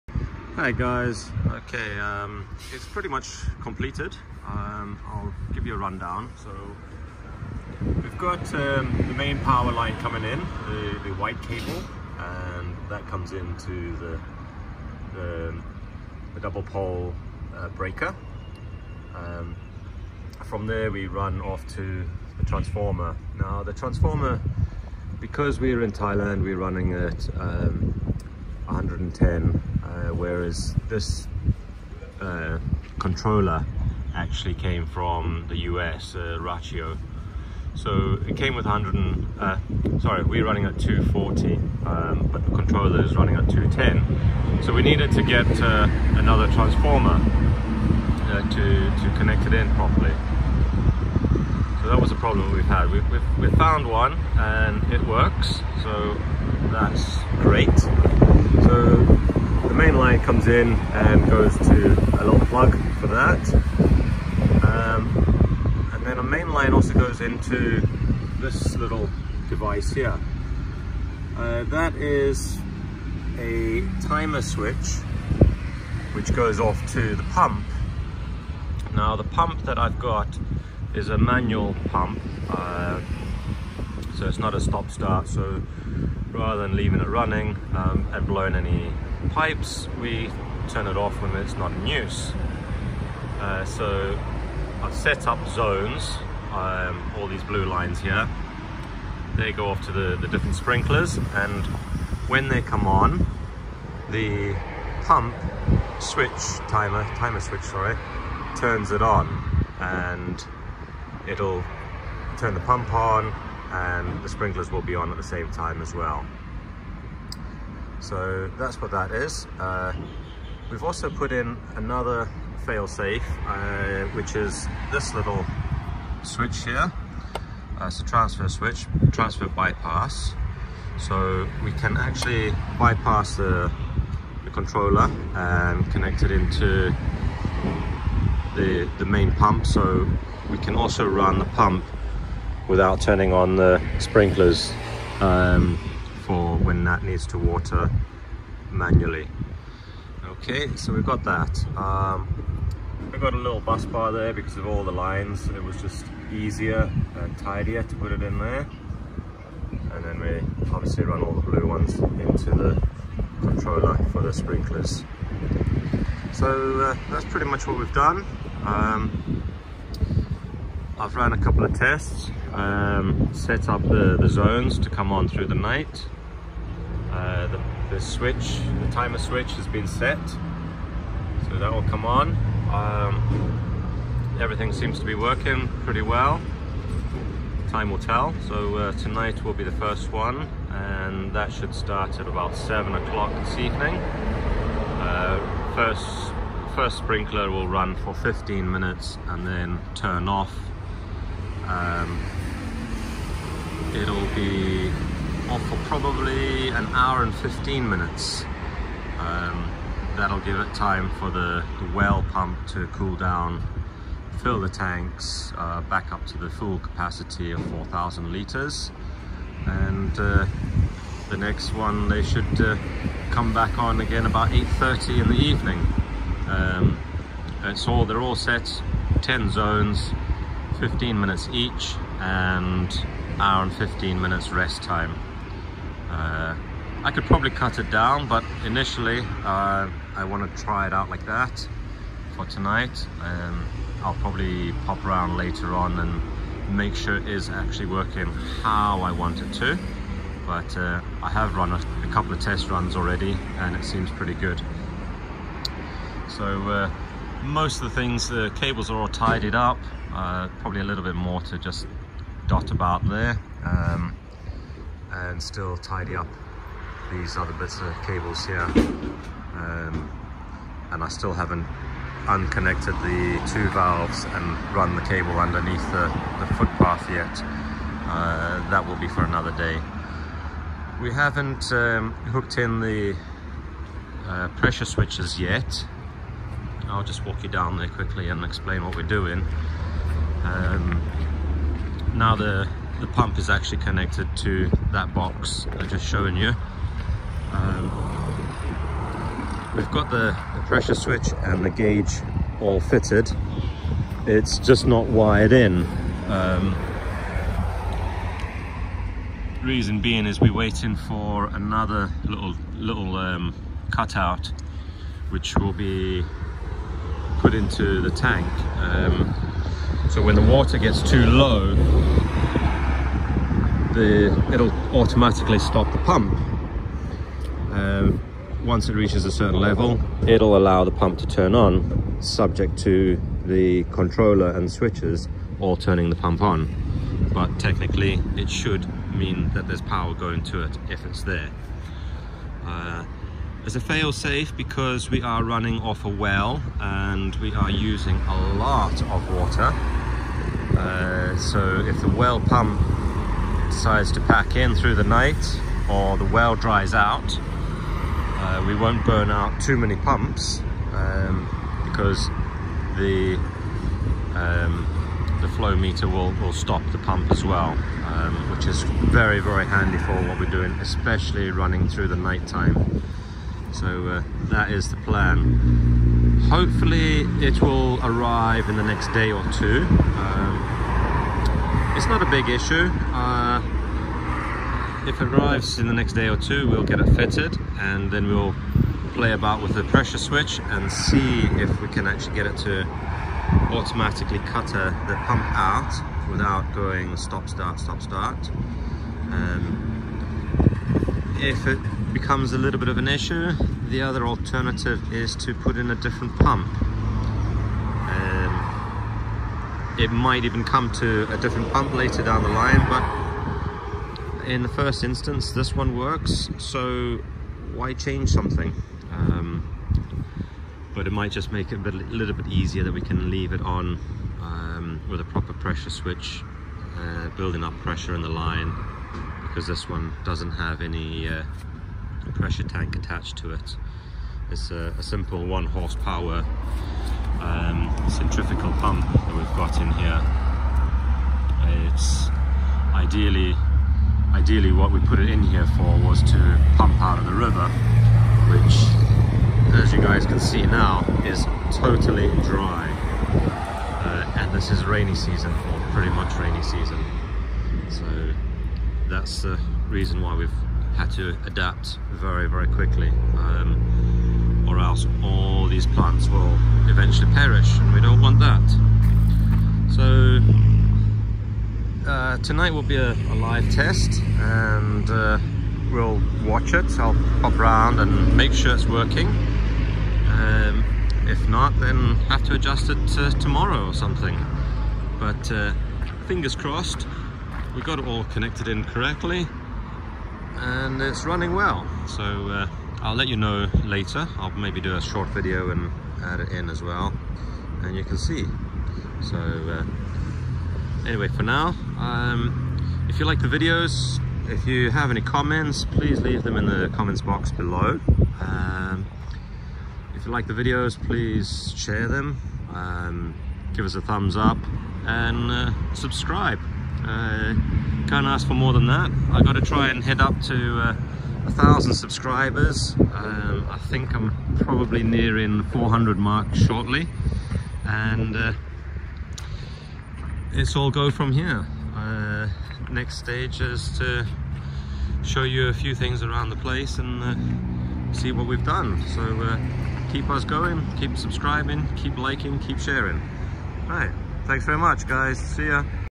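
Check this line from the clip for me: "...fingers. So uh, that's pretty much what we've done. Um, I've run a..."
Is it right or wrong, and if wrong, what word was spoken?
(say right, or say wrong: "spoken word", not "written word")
wrong: "sprinklers", not "fingers".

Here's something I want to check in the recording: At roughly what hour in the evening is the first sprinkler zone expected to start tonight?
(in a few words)
7 o'clock.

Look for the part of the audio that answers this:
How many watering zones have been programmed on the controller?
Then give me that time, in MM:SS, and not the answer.
03:49.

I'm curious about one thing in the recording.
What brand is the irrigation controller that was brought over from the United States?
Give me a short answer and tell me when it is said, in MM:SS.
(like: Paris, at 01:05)
Rachio, at 00:36.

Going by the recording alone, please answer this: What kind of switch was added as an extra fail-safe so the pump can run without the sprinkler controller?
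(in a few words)
transfer switch.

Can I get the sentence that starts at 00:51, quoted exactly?
So that was a problem we've had.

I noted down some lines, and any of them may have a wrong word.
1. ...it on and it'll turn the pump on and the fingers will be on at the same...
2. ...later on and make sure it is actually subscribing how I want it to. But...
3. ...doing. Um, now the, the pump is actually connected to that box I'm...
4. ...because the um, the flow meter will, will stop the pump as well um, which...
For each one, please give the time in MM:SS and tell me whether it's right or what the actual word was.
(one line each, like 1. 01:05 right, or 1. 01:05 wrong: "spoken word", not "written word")
1. 01:48 wrong: "sprinklers", not "fingers"
2. 04:05 wrong: "working", not "subscribing"
3. 04:49 right
4. 06:01 right.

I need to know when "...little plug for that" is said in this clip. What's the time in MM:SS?
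01:02.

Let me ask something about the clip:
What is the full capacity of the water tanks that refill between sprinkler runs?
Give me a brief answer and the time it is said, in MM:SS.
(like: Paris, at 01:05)
4,000 litres, at 03:37.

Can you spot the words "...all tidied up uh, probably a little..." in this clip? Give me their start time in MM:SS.
04:18.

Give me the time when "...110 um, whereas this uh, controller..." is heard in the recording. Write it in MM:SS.
00:28.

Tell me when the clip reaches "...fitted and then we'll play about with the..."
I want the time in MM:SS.
06:27.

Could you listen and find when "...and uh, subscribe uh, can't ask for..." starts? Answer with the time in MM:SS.
08:35.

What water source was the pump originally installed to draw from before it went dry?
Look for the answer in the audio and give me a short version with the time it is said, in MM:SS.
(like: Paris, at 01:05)
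the river, at 07:27.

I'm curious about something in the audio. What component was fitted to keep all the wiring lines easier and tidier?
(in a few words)
bus bar.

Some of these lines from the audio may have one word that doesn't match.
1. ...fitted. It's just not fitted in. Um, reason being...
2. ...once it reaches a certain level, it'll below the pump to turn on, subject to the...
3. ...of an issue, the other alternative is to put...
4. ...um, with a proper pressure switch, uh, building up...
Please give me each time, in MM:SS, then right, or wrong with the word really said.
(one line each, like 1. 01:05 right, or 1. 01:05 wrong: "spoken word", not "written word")
1. 05:02 wrong: "wired", not "fitted"
2. 05:28 wrong: "allow", not "below"
3. 06:42 right
4. 07:04 right.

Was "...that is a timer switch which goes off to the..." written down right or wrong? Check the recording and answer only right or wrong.
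right.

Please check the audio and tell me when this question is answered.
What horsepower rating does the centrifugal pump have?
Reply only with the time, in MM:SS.
07:15.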